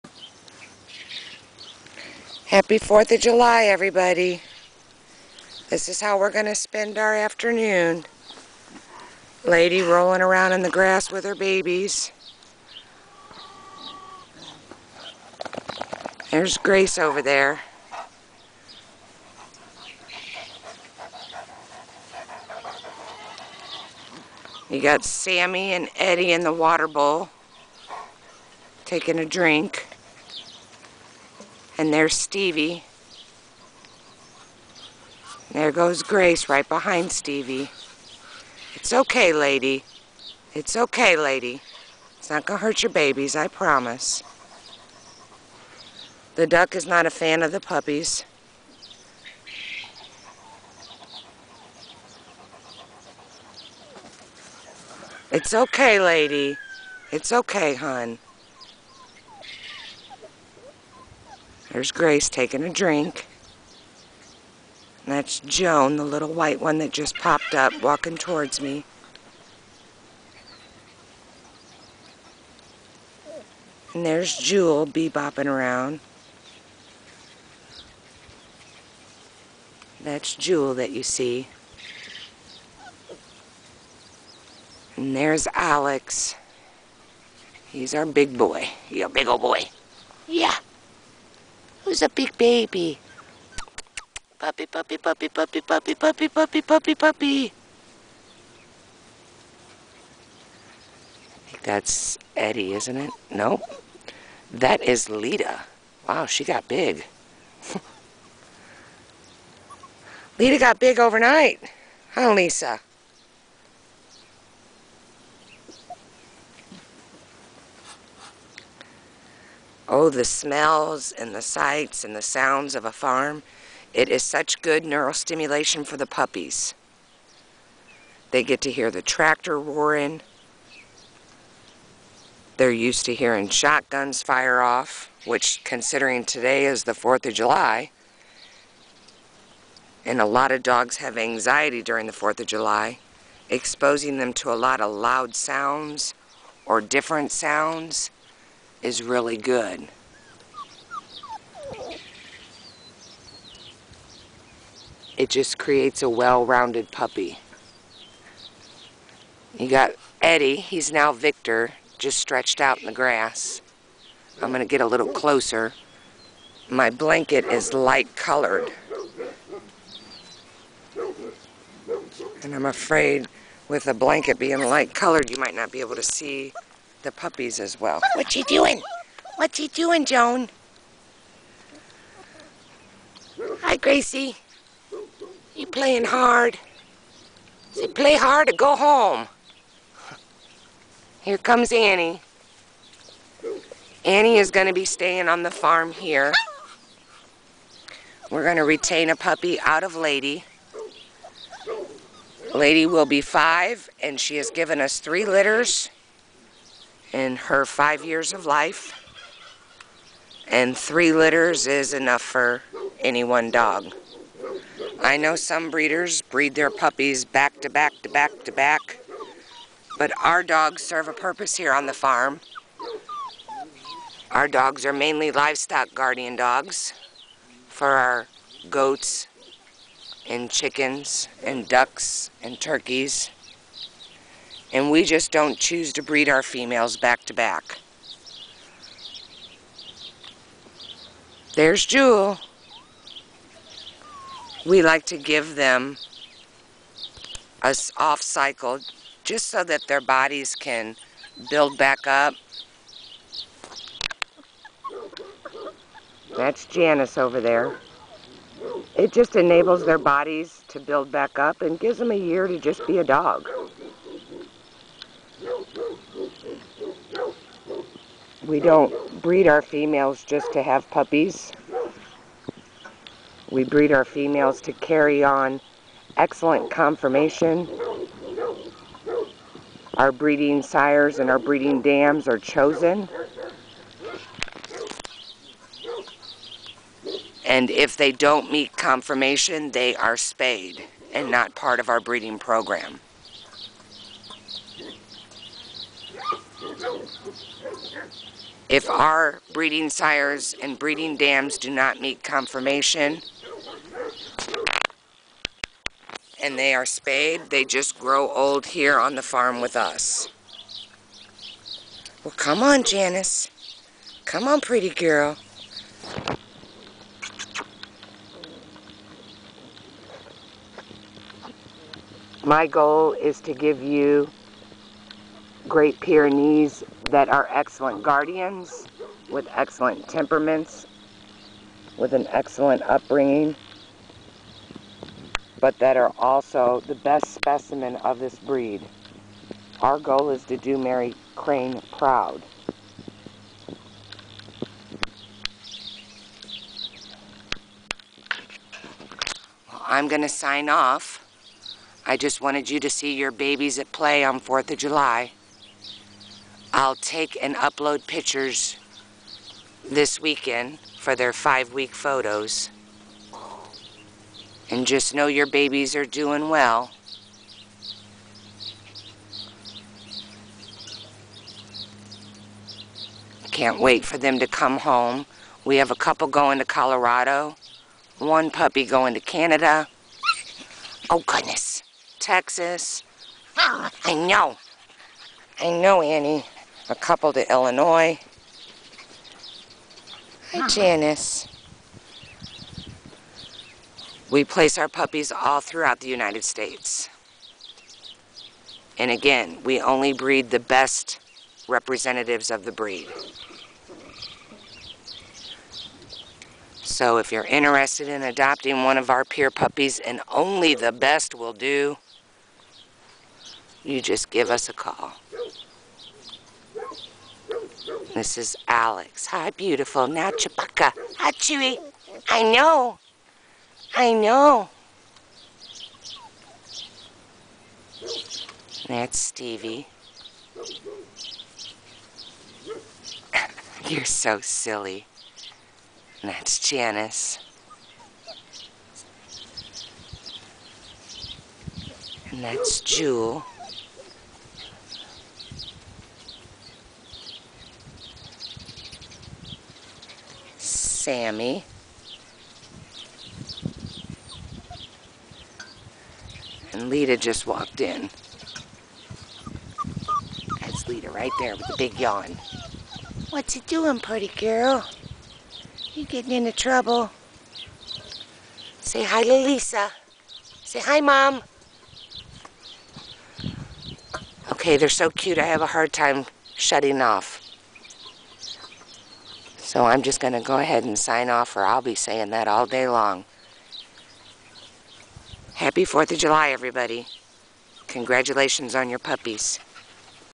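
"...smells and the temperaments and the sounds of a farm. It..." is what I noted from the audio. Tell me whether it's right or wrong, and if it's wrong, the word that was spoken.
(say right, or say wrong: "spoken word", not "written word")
wrong: "sights", not "temperaments".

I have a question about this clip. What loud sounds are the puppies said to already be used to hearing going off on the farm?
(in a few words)
Shotguns.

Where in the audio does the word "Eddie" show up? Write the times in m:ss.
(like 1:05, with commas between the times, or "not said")
0:25, 1:42, 2:40.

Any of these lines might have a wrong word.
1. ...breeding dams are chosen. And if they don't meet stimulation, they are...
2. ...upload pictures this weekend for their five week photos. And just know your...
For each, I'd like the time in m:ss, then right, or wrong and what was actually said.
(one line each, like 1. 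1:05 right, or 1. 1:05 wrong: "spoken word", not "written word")
1. 4:41 wrong: "conformation", not "stimulation"
2. 5:57 right.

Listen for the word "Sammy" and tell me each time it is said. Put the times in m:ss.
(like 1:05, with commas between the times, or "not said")
0:25, 7:31.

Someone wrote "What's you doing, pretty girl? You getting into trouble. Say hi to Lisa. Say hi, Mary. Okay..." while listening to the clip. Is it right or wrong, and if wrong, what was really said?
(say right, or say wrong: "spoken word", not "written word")
wrong: "Mom", not "Mary".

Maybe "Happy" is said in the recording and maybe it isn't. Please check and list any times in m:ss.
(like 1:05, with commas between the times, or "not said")
0:02, 8:05.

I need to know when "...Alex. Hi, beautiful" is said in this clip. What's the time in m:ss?
6:58.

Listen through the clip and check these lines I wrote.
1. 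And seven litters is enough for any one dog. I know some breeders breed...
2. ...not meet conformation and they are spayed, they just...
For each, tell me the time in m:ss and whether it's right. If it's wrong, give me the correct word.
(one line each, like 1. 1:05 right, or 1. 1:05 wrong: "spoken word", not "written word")
1. 3:30 wrong: "three", not "seven"
2. 5:01 right.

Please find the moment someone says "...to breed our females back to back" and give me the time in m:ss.
3:55.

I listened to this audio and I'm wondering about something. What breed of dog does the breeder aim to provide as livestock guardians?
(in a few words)
Great Pyrenees.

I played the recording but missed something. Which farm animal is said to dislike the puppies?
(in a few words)
The duck.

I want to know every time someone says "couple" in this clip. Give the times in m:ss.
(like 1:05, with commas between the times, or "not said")
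6:16, 6:26.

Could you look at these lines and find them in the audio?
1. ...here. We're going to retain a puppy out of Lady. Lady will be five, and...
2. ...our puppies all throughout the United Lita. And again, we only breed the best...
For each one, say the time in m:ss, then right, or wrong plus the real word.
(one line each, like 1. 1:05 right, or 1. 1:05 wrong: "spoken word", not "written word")
1. 3:15 right
2. 6:34 wrong: "States", not "Lita".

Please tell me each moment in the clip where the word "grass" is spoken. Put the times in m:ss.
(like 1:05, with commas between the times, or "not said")
0:10, 2:42.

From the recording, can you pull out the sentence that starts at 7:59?
So I'm just going to go ahead and sign off or I'll be saying that all day long.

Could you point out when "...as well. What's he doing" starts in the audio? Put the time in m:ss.
2:57.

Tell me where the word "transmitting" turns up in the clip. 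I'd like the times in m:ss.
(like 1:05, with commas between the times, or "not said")
not said.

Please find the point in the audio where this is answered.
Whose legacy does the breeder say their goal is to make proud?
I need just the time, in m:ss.
5:40.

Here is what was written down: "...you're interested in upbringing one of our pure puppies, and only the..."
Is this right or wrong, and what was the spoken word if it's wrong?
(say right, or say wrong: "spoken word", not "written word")
wrong: "adopting", not "upbringing".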